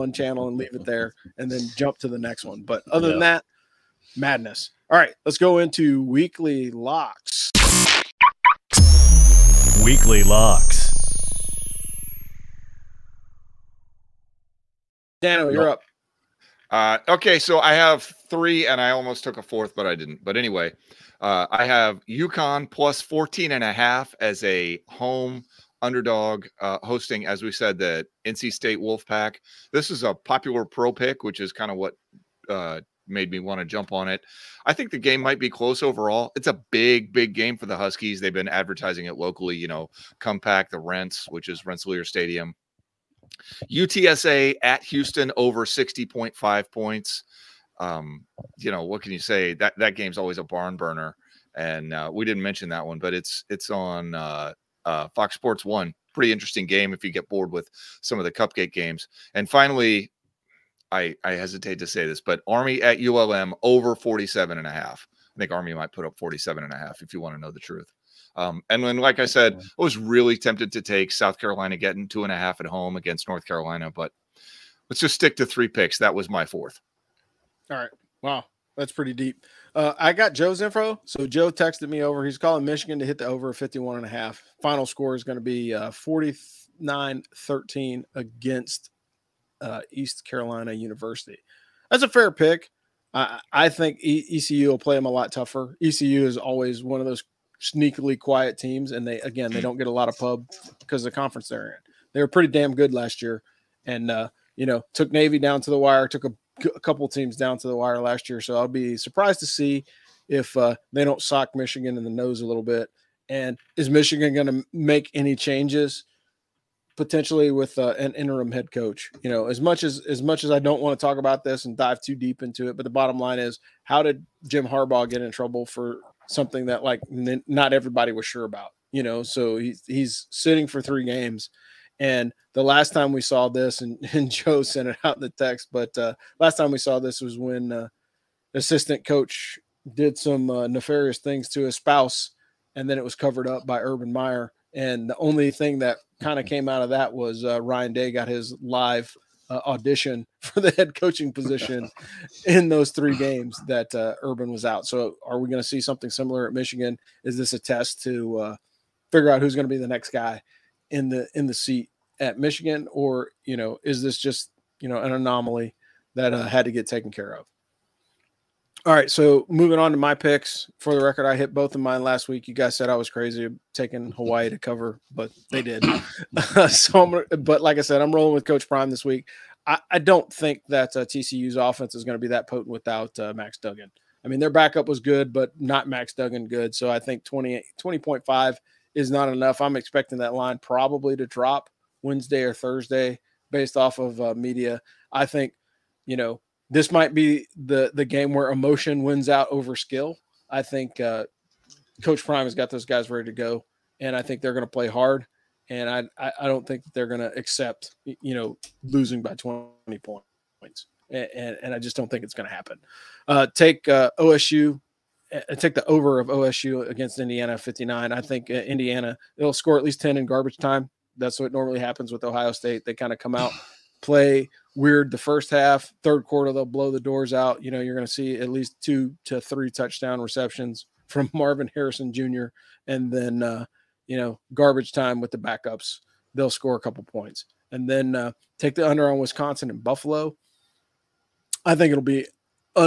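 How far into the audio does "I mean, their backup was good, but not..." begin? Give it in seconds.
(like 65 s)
184 s.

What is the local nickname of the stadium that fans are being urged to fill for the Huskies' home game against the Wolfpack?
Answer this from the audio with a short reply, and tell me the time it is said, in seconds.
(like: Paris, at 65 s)
the Rents, at 40 s.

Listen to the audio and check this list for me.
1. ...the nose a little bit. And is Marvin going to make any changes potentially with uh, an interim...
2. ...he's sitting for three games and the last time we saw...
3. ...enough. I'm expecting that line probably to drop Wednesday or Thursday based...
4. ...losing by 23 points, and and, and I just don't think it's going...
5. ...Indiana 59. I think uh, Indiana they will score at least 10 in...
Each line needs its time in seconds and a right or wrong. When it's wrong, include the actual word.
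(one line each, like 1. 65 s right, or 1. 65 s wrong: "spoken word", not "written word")
1. 112 s wrong: "Michigan", not "Marvin"
2. 129 s right
3. 189 s right
4. 208 s wrong: "20", not "23"
5. 217 s right.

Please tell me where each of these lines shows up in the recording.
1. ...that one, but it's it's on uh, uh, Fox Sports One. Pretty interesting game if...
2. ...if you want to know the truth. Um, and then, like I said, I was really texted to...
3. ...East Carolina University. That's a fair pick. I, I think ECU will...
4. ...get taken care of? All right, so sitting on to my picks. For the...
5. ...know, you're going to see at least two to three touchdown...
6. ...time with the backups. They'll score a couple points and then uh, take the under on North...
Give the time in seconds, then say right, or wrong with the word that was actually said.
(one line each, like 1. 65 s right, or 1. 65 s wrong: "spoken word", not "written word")
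1. 52 s right
2. 67 s wrong: "tempted", not "texted"
3. 89 s right
4. 166 s wrong: "moving", not "sitting"
5. 227 s right
6. 234 s wrong: "Wisconsin", not "North".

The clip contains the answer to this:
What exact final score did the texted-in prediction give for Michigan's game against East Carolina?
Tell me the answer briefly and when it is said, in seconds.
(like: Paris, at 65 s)
49-13, at 85 s.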